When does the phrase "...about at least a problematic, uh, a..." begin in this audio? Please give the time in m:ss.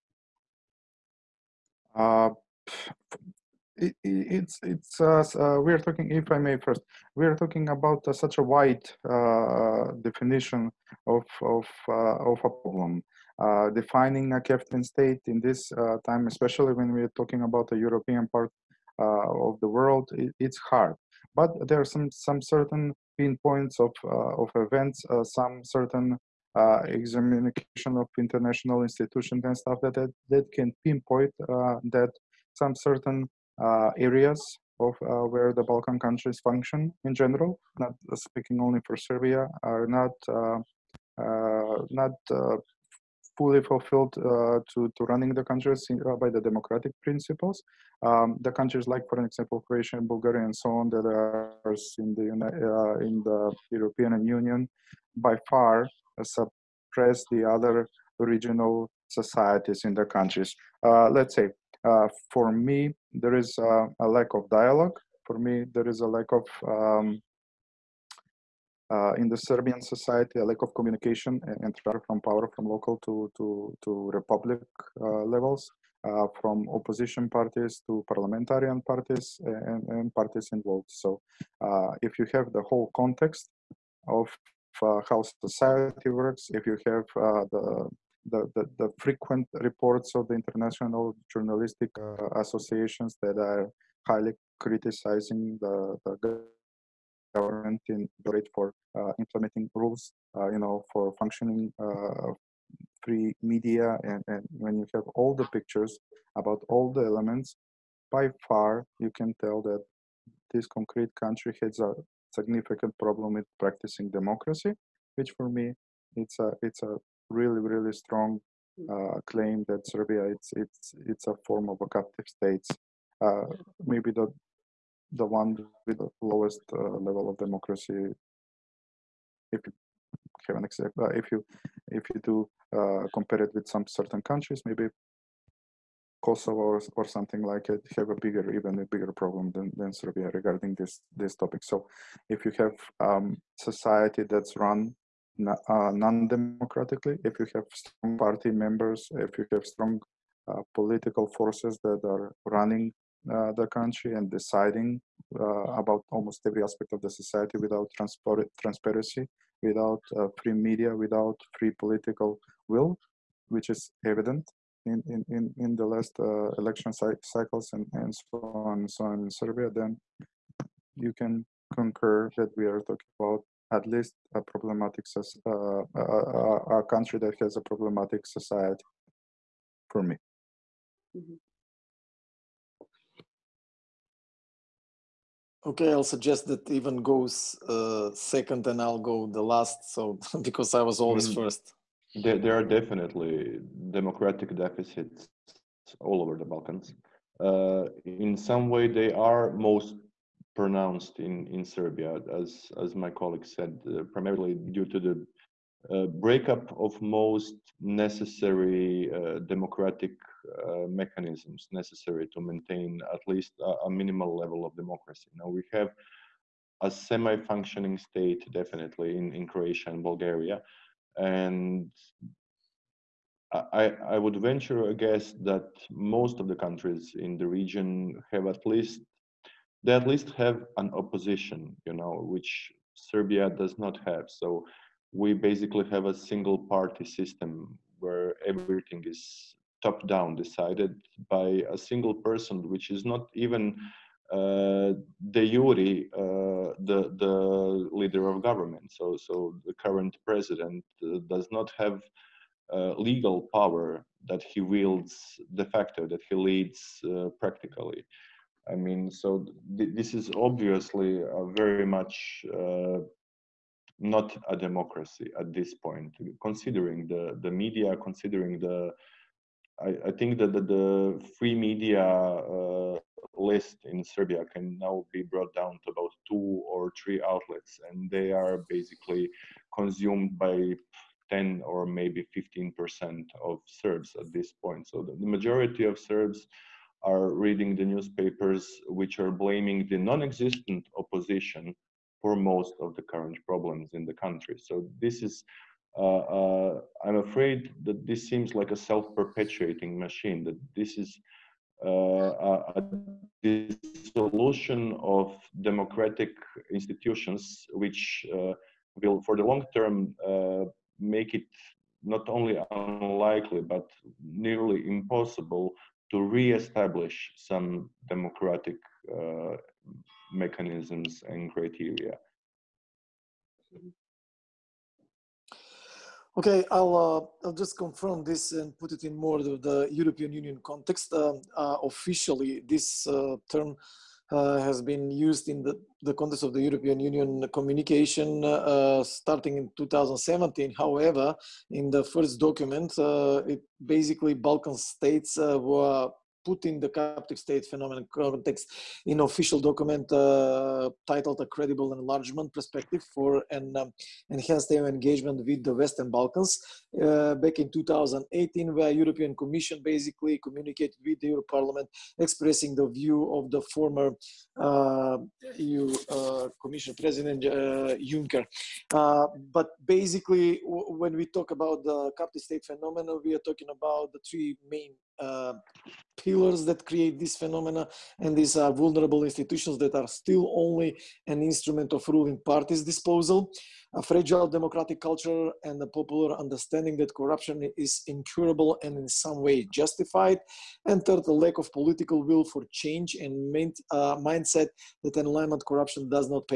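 2:53.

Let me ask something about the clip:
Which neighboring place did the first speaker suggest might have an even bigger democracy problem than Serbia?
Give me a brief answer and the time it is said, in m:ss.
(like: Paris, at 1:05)
Kosovo, at 2:16.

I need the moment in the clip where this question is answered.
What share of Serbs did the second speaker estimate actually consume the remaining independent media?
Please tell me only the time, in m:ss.
4:41.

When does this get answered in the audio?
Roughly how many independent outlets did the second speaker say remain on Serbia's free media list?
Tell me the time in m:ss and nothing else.
4:36.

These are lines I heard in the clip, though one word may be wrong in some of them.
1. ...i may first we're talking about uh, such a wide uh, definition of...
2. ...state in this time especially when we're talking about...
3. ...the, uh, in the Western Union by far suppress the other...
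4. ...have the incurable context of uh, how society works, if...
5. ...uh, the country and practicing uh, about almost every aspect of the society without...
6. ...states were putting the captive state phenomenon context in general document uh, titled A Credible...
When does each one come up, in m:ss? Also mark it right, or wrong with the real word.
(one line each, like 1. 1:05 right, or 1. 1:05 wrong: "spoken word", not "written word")
1. 0:06 right
2. 0:14 right
3. 0:52 wrong: "European", not "Western"
4. 1:22 wrong: "whole", not "incurable"
5. 2:33 wrong: "deciding", not "practicing"
6. 5:44 wrong: "official", not "general".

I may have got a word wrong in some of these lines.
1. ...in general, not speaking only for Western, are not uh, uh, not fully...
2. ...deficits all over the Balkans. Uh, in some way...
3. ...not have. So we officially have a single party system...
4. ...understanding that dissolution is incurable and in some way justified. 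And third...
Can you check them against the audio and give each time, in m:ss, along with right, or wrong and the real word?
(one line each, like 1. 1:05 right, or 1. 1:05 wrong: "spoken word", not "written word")
1. 0:37 wrong: "Serbia", not "Western"
2. 3:14 right
3. 3:53 wrong: "basically", not "officially"
4. 6:26 wrong: "corruption", not "dissolution".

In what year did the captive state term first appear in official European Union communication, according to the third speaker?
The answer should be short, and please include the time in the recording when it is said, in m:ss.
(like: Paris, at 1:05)
2017, at 5:39.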